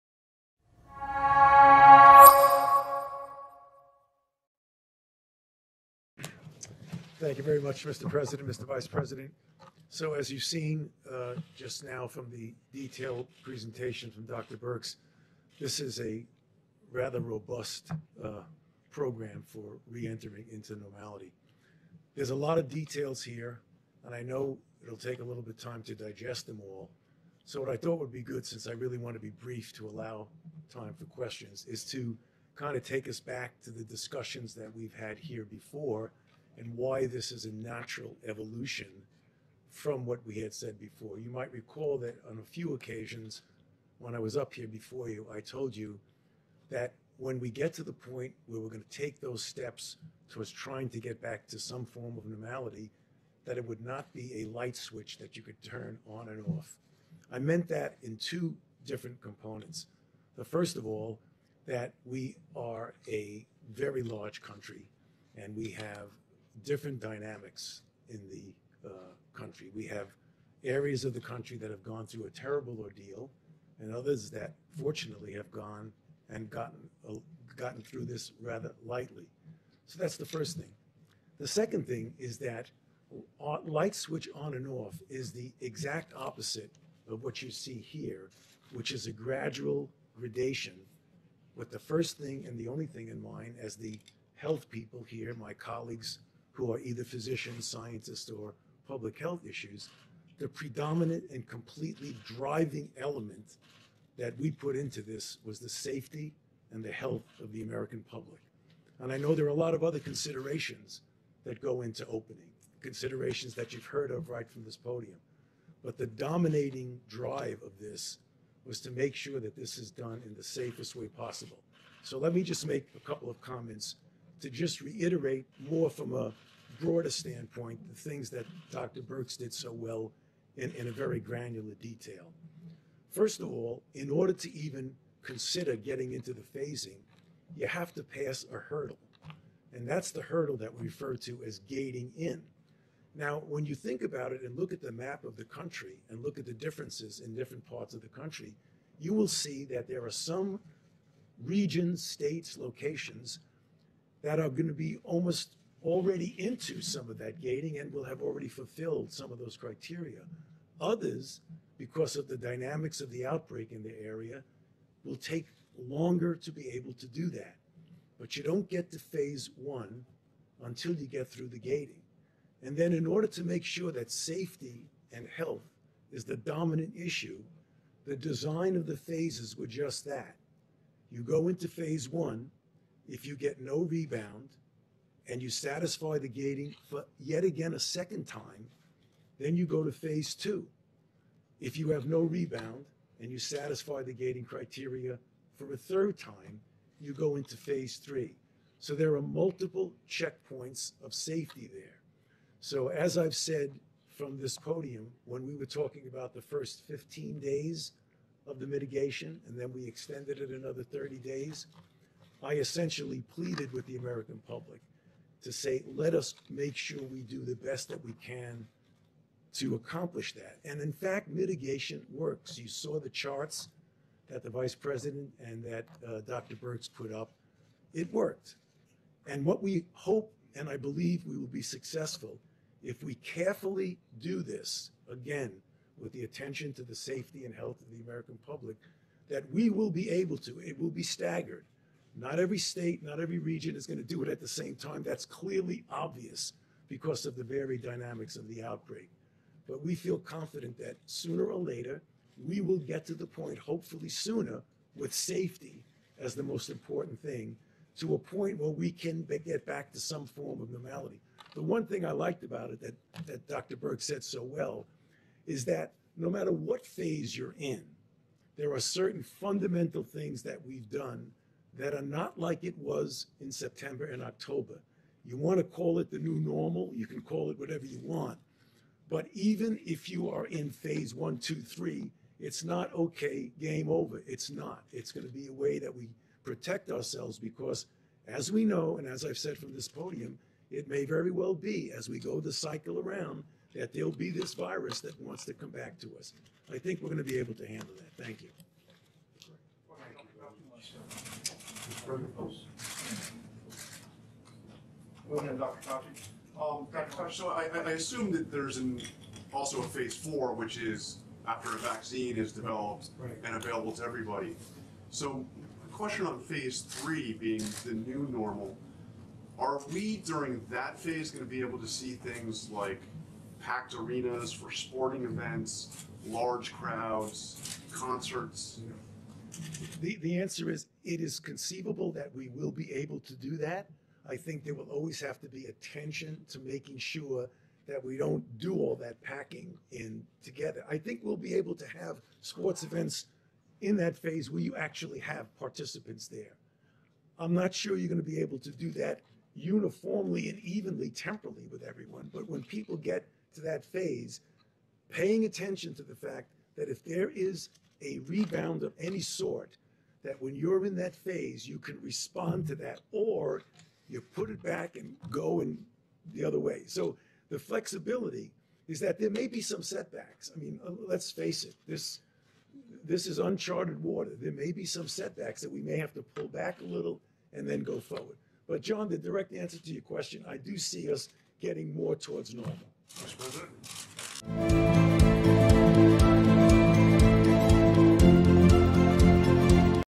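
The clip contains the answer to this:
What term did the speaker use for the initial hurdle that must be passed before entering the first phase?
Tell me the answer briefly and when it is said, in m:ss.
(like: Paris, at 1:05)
gating in, at 2:21.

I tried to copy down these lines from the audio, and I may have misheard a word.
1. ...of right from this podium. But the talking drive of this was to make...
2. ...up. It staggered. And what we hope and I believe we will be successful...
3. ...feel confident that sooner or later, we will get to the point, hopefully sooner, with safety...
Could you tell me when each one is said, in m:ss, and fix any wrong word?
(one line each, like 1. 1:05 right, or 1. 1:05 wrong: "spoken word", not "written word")
1. 1:54 wrong: "dominating", not "talking"
2. 3:47 wrong: "worked", not "staggered"
3. 4:09 right.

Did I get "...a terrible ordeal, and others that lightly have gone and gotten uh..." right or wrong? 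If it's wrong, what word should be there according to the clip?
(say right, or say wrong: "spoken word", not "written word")
wrong: "fortunately", not "lightly".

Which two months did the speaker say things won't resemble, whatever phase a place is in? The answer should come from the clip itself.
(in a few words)
September and October.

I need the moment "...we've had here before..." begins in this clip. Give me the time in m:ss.
0:34.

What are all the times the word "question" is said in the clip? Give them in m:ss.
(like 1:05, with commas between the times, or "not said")
0:31, 5:15, 6:20.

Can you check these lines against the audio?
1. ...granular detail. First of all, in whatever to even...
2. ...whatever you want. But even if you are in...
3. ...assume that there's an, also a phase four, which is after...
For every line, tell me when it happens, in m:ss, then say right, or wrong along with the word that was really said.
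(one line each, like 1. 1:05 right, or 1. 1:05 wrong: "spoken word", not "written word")
1. 2:11 wrong: "order", not "whatever"
2. 4:37 right
3. 5:07 right.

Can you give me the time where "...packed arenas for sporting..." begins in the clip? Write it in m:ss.
5:23.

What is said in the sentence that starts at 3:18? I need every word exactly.
So there are multiple checkpoints of safety there.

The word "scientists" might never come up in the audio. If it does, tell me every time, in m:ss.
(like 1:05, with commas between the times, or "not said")
1:37.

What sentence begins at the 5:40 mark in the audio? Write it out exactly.
I think we'll be able to have sports events in that phase where you actually have participants there.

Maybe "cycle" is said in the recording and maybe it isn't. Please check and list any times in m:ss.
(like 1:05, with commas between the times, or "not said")
4:52.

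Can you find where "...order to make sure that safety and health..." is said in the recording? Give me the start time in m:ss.
2:53.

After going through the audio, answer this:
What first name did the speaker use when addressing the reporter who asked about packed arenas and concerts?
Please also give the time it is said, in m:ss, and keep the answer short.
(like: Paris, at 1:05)
John, at 6:18.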